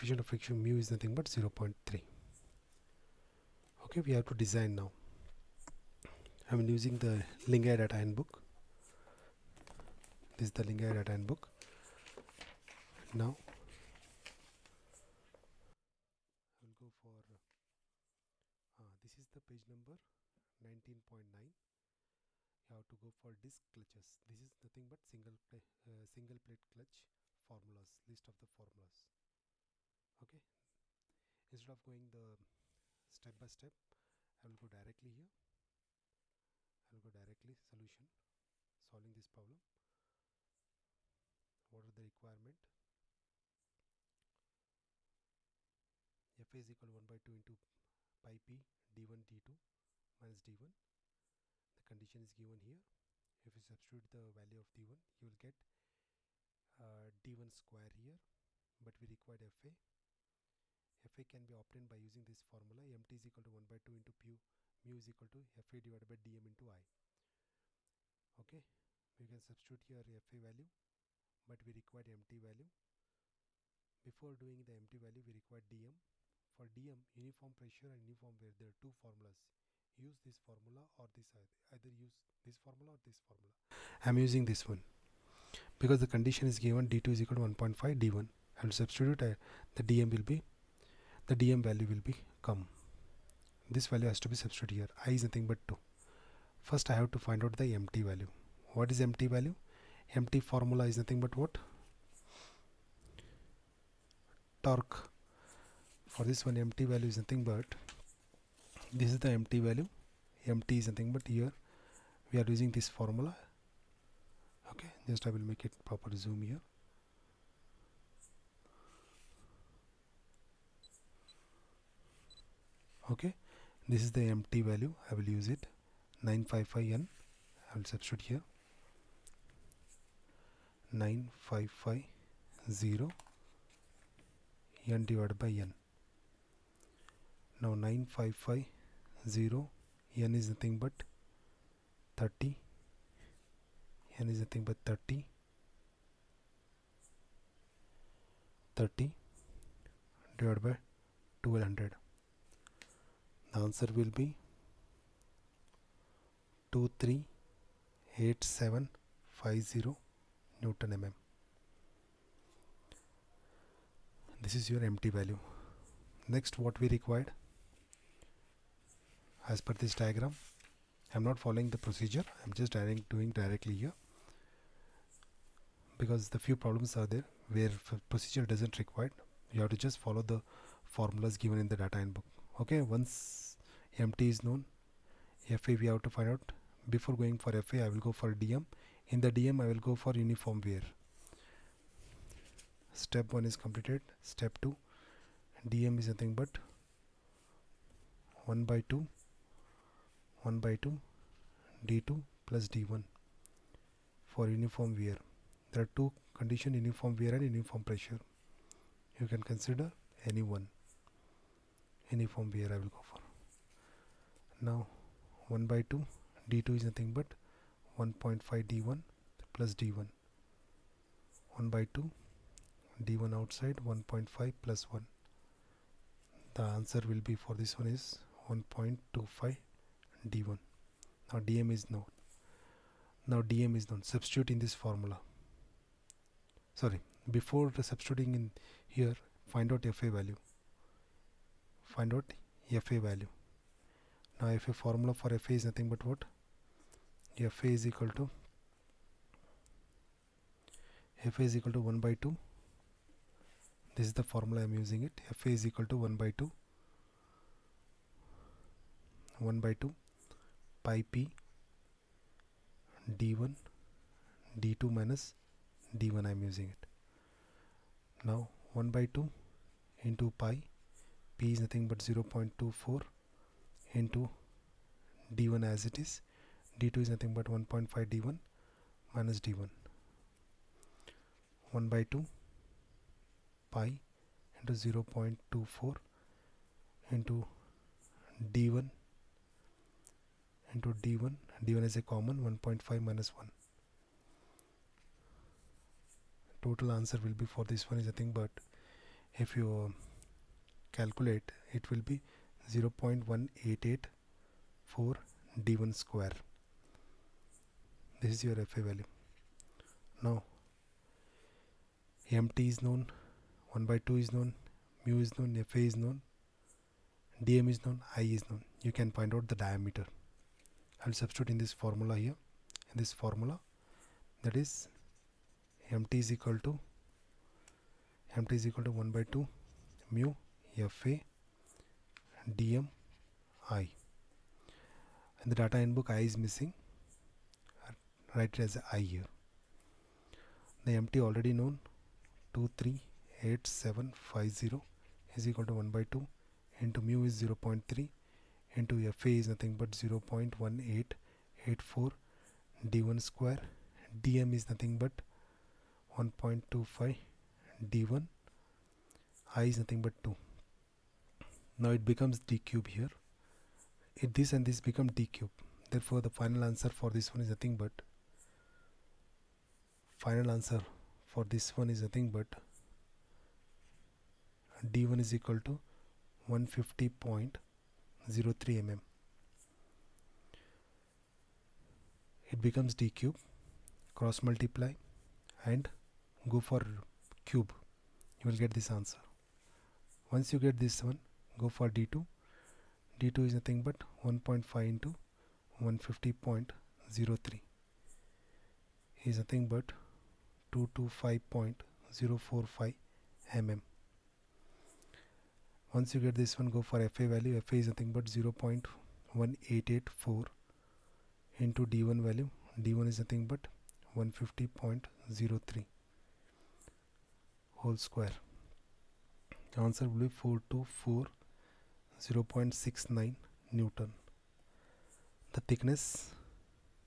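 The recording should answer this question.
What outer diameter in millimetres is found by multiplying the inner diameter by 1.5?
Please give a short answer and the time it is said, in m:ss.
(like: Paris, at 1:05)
225.045 mm, at 6:40.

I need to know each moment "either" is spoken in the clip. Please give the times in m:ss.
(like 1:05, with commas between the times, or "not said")
1:21.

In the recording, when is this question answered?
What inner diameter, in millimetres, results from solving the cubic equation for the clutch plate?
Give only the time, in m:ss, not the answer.
6:16.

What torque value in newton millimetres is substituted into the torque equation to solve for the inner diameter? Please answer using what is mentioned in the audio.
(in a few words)
238750.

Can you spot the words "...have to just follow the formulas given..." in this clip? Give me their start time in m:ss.
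2:59.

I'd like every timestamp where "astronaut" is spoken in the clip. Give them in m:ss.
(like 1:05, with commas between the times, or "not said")
not said.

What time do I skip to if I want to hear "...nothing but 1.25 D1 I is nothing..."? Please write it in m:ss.
5:54.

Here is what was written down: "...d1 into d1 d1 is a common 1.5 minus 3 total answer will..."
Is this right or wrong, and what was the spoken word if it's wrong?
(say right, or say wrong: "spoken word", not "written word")
wrong: "1", not "3".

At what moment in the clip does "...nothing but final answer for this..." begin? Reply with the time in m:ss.
6:07.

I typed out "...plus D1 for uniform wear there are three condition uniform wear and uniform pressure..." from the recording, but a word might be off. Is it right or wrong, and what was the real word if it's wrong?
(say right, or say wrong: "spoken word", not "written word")
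wrong: "two", not "three".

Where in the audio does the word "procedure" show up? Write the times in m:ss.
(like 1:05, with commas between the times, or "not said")
2:51, 2:58.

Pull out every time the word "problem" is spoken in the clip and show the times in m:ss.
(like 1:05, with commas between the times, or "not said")
0:39, 2:56.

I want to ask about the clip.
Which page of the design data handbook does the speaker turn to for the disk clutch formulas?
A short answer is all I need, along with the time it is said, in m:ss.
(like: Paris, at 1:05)
19.9, at 0:20.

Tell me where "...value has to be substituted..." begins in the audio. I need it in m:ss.
1:33.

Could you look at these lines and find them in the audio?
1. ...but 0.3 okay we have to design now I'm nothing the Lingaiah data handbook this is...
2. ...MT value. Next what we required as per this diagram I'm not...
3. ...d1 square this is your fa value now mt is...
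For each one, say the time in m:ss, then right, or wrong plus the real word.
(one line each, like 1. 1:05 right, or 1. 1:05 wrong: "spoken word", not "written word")
1. 0:01 wrong: "using", not "nothing"
2. 2:44 right
3. 5:05 right.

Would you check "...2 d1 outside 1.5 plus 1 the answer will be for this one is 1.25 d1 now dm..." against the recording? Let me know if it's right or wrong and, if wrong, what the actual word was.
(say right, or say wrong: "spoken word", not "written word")
right.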